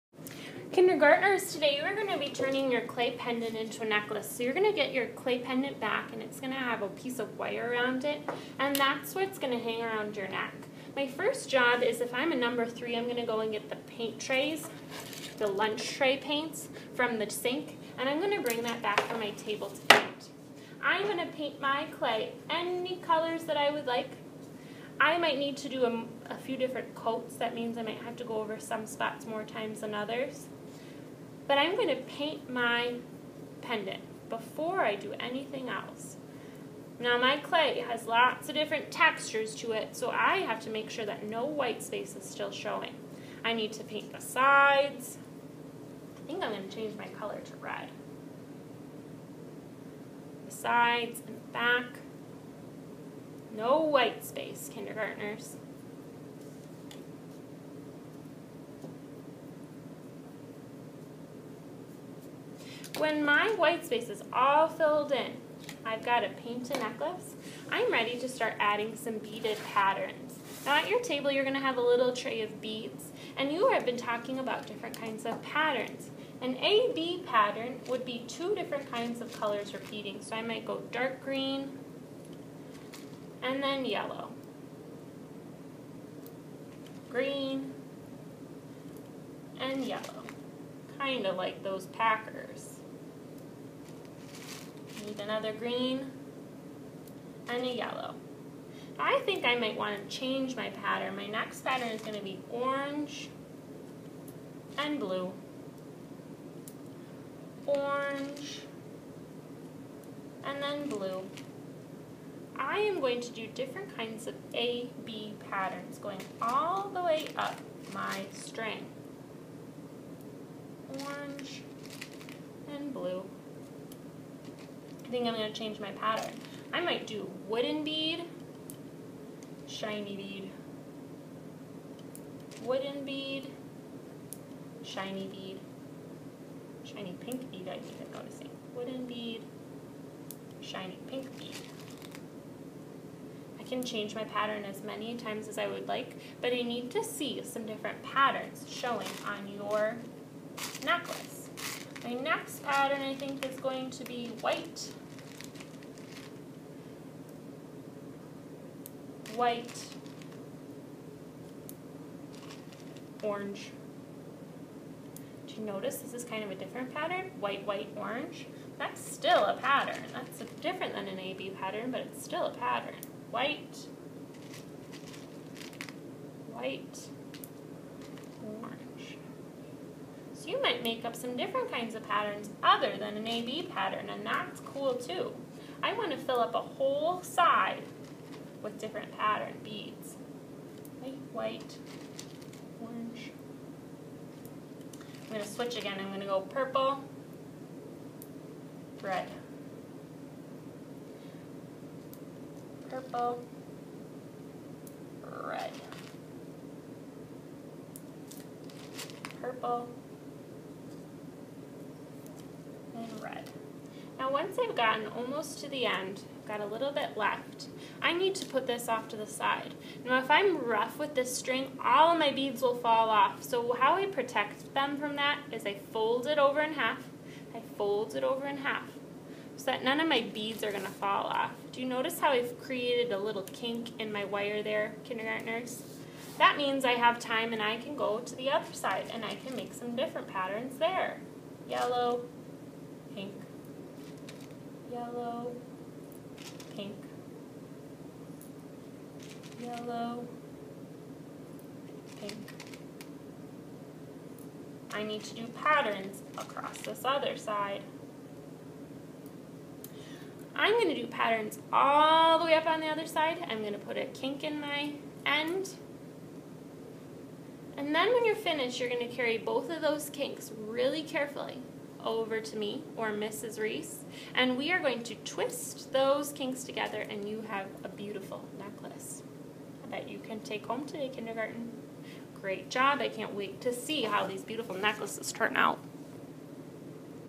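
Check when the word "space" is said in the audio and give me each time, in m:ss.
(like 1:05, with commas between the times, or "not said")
0:41, 0:54, 1:03.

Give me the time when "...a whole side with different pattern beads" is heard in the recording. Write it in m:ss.
3:06.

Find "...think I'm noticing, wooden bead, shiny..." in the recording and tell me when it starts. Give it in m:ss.
2:17.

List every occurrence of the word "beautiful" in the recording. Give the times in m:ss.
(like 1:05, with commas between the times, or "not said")
4:37, 4:44.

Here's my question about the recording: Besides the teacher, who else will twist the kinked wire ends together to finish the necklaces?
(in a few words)
Mrs. Reese.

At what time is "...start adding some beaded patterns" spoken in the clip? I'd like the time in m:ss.
1:08.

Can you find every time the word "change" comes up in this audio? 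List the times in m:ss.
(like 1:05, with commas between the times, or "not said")
0:46, 1:40, 2:05, 2:23.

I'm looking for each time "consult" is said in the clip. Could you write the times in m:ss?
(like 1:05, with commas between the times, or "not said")
not said.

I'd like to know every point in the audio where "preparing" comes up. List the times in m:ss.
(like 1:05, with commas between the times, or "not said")
not said.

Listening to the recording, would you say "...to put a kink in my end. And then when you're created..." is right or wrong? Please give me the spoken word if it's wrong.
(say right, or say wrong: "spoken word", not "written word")
wrong: "finished", not "created".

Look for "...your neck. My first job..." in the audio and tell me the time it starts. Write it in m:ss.
0:10.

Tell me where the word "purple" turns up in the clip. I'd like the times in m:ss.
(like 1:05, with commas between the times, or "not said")
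3:16, 3:22, 3:29.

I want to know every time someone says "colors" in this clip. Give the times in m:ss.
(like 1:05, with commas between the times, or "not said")
0:23, 0:47, 1:19.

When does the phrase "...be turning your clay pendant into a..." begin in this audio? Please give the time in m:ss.
0:02.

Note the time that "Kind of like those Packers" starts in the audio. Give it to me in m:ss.
1:30.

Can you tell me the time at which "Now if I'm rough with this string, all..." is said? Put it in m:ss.
3:40.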